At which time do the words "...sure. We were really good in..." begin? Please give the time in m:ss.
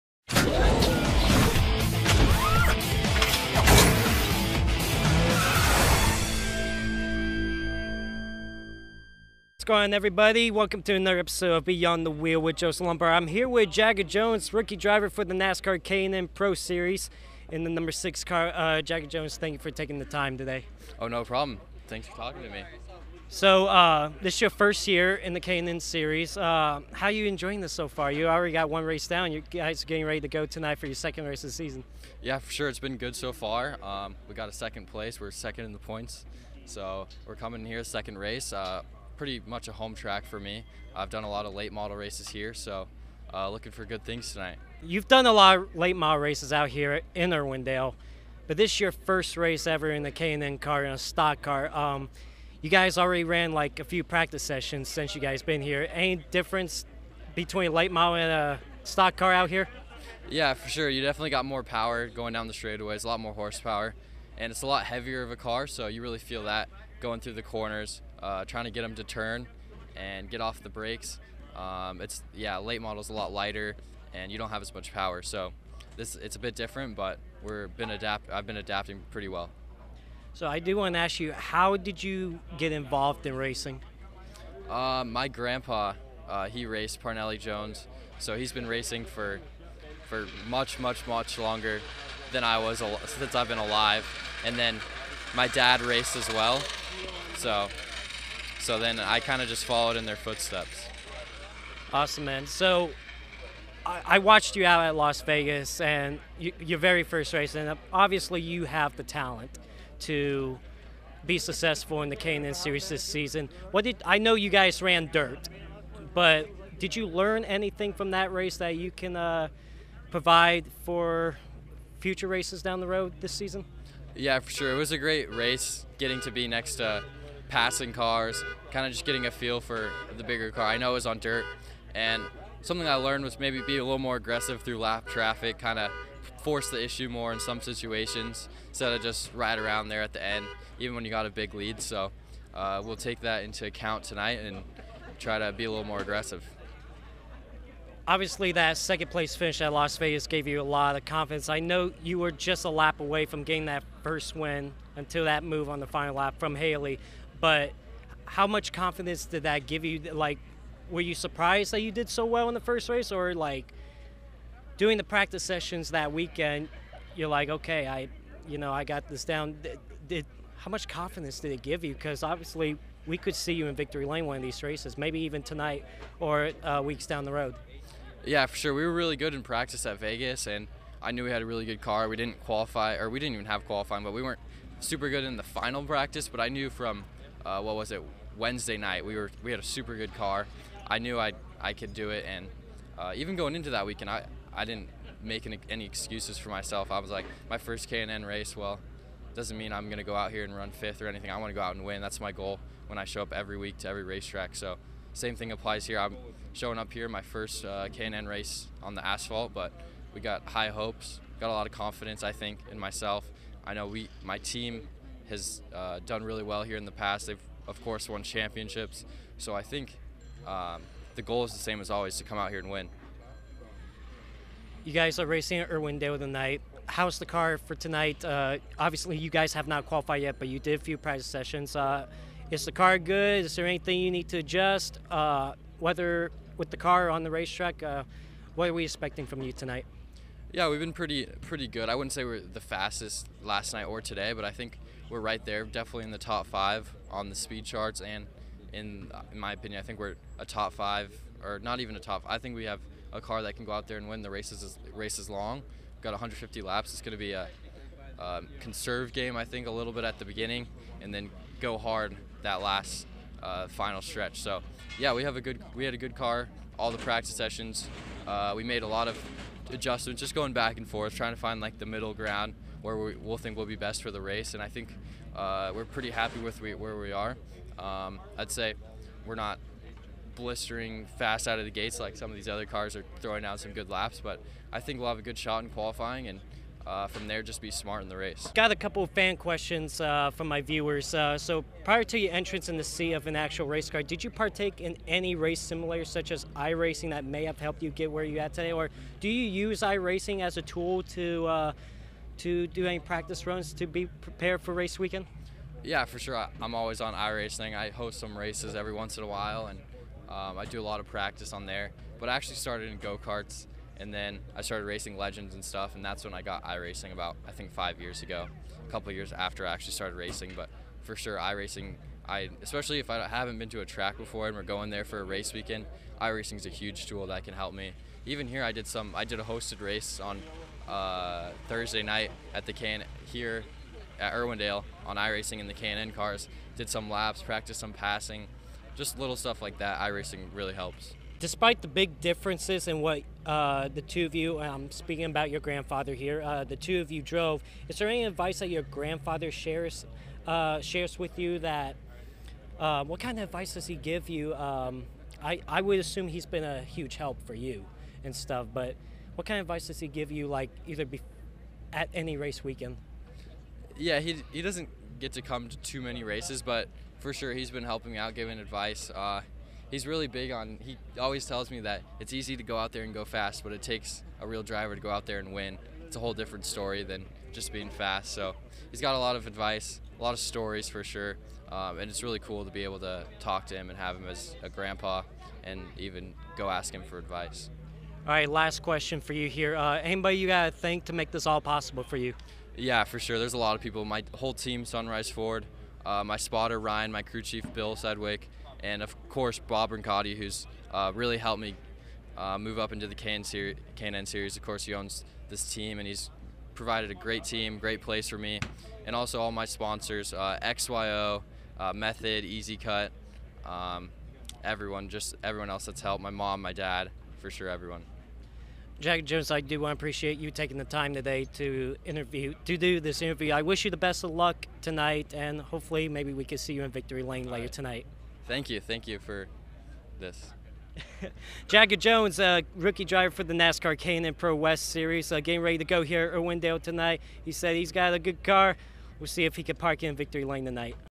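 2:58.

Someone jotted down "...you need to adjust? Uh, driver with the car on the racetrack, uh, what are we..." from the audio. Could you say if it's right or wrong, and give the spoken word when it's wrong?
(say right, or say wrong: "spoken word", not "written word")
wrong: "whether", not "driver".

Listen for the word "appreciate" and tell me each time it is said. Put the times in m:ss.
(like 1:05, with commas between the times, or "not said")
6:59.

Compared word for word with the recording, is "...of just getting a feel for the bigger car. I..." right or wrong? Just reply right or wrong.
right.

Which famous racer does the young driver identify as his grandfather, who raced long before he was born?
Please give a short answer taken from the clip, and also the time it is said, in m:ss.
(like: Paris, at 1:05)
Parnelli Jones, at 1:27.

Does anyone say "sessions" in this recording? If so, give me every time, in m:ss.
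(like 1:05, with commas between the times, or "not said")
0:54, 2:45, 3:51, 4:27.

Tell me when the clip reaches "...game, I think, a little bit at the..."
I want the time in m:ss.
4:19.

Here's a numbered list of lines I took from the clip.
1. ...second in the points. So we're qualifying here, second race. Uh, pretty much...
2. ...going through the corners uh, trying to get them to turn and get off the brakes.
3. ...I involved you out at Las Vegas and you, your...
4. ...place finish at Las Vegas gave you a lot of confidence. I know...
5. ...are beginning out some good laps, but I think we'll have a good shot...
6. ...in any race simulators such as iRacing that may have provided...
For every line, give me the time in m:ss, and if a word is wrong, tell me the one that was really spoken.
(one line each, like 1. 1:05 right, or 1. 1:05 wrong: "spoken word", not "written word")
1. 0:35 wrong: "coming", not "qualifying"
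2. 1:07 right
3. 1:44 wrong: "watched", not "involved"
4. 2:29 right
5. 4:42 wrong: "throwing", not "beginning"
6. 4:54 wrong: "helped", not "provided".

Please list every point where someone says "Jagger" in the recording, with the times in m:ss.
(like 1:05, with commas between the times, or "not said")
0:13, 0:18, 7:11.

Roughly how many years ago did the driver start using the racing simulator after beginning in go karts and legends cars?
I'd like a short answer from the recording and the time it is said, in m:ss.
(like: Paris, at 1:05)
5, at 5:17.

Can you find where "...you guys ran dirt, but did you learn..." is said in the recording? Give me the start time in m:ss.
1:54.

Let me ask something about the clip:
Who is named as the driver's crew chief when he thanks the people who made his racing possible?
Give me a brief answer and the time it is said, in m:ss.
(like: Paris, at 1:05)
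Bill Sedgwick, at 6:37.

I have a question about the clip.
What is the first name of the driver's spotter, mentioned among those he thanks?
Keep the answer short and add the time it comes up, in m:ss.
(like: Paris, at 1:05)
Ryan, at 6:36.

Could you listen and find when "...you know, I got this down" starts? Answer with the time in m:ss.
2:48.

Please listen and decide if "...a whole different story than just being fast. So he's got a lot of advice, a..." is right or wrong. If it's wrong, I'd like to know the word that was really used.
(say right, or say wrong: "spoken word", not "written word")
right.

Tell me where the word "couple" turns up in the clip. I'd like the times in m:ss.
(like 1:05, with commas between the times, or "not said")
4:48, 5:18.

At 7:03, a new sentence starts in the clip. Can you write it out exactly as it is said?
I wish you the best of luck tonight, and hopefully, maybe we can see you in victory lane later right.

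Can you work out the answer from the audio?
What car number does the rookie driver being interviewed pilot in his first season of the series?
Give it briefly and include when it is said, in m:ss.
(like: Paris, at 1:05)
6, at 0:17.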